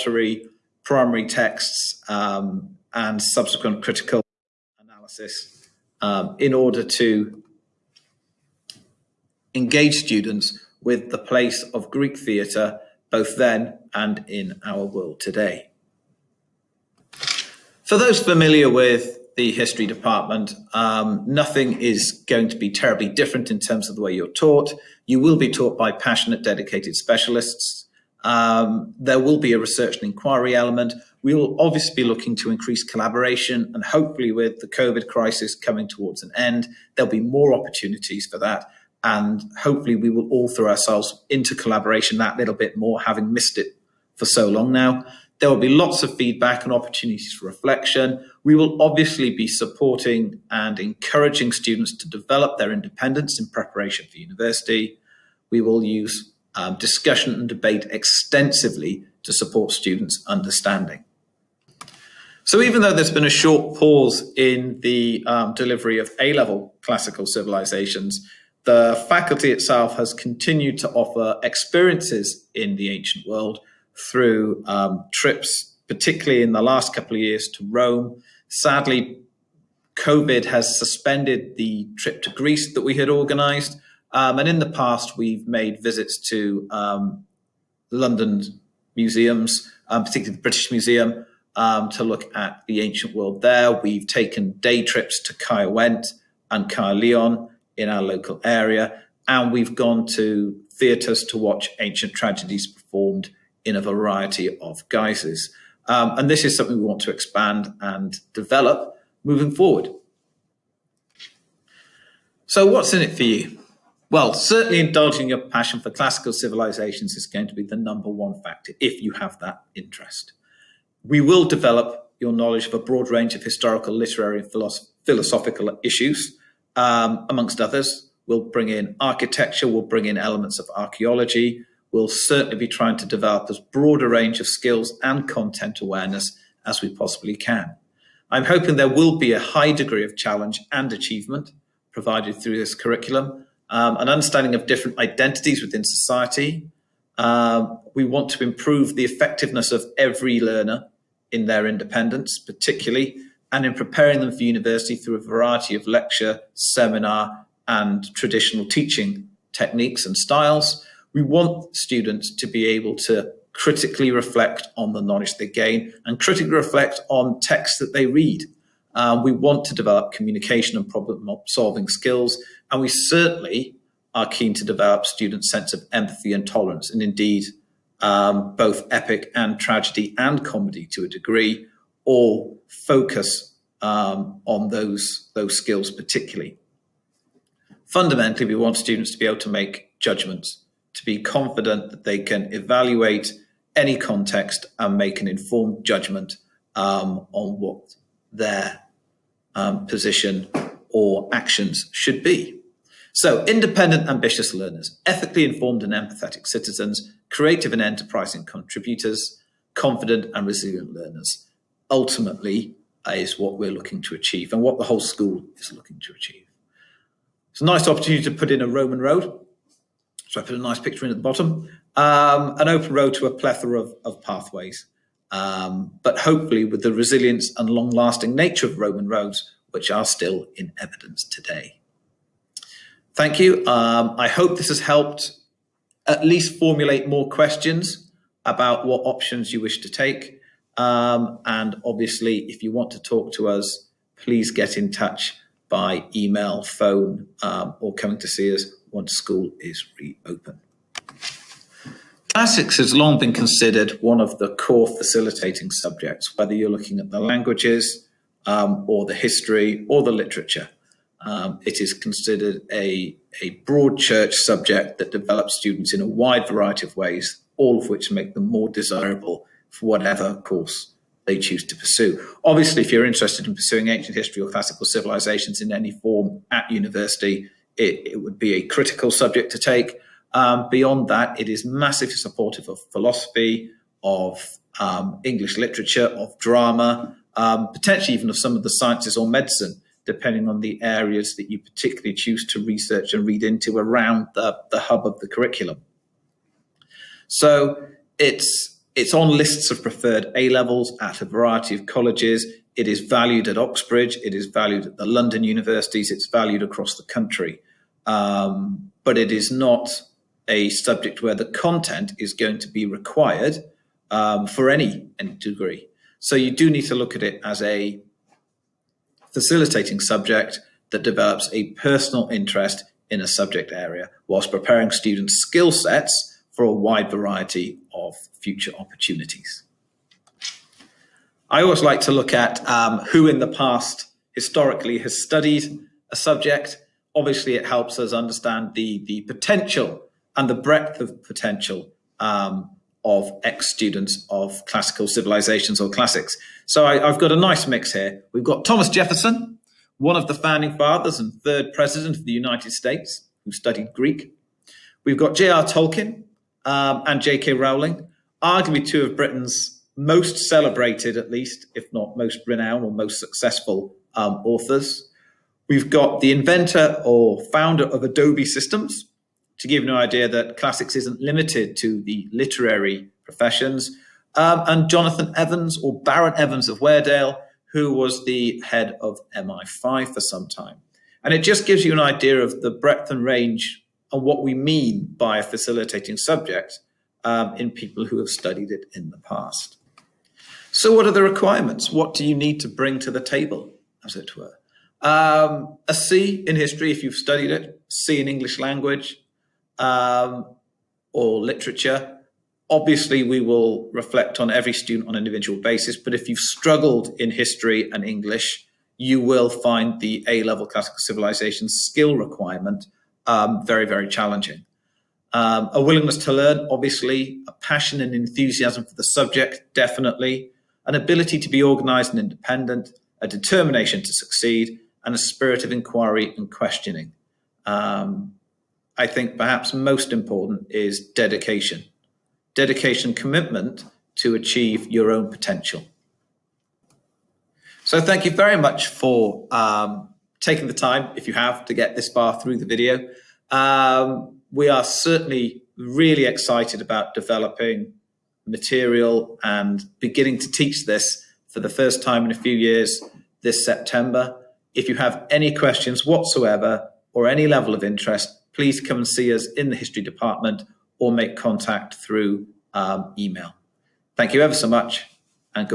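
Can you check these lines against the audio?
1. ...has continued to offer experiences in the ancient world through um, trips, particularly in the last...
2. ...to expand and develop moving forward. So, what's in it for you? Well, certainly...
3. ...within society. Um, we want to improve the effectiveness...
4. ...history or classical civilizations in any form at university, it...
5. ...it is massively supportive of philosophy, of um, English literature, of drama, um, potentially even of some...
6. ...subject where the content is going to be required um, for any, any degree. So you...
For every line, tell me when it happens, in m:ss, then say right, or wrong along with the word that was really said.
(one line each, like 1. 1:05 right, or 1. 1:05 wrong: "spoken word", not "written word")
1. 1:09 right
2. 1:47 right
3. 2:25 right
4. 4:34 right
5. 4:41 right
6. 5:10 right.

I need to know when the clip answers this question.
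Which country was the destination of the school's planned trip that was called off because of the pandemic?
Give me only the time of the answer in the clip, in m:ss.
1:22.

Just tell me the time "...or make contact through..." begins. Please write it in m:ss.
7:40.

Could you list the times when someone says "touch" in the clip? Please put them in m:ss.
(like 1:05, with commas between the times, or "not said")
4:04.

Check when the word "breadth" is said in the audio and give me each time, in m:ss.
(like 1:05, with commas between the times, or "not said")
5:40, 6:22.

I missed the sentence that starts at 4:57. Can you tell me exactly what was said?
So it's it's on lists of preferred A levels at a variety of colleges.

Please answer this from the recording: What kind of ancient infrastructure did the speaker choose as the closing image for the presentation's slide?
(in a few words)
Roman road.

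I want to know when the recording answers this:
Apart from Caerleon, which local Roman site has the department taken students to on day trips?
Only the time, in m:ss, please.
1:35.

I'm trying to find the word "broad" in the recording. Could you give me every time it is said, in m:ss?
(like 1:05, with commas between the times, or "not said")
2:02, 2:13, 4:23.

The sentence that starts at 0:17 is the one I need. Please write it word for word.
For those familiar with the history department, um, nothing is going to be terribly different in terms of the way you're taught.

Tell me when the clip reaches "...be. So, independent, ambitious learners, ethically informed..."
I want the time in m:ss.
3:22.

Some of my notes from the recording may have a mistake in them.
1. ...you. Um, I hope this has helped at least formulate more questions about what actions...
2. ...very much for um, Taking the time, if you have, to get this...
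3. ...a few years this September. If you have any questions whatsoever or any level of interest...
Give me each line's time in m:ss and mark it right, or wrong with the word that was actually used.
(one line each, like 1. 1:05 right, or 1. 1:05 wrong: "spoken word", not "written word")
1. 3:53 wrong: "options", not "actions"
2. 7:18 right
3. 7:32 right.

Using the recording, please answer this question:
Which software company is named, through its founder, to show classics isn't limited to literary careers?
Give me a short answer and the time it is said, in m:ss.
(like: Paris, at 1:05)
Adobe Systems, at 6:08.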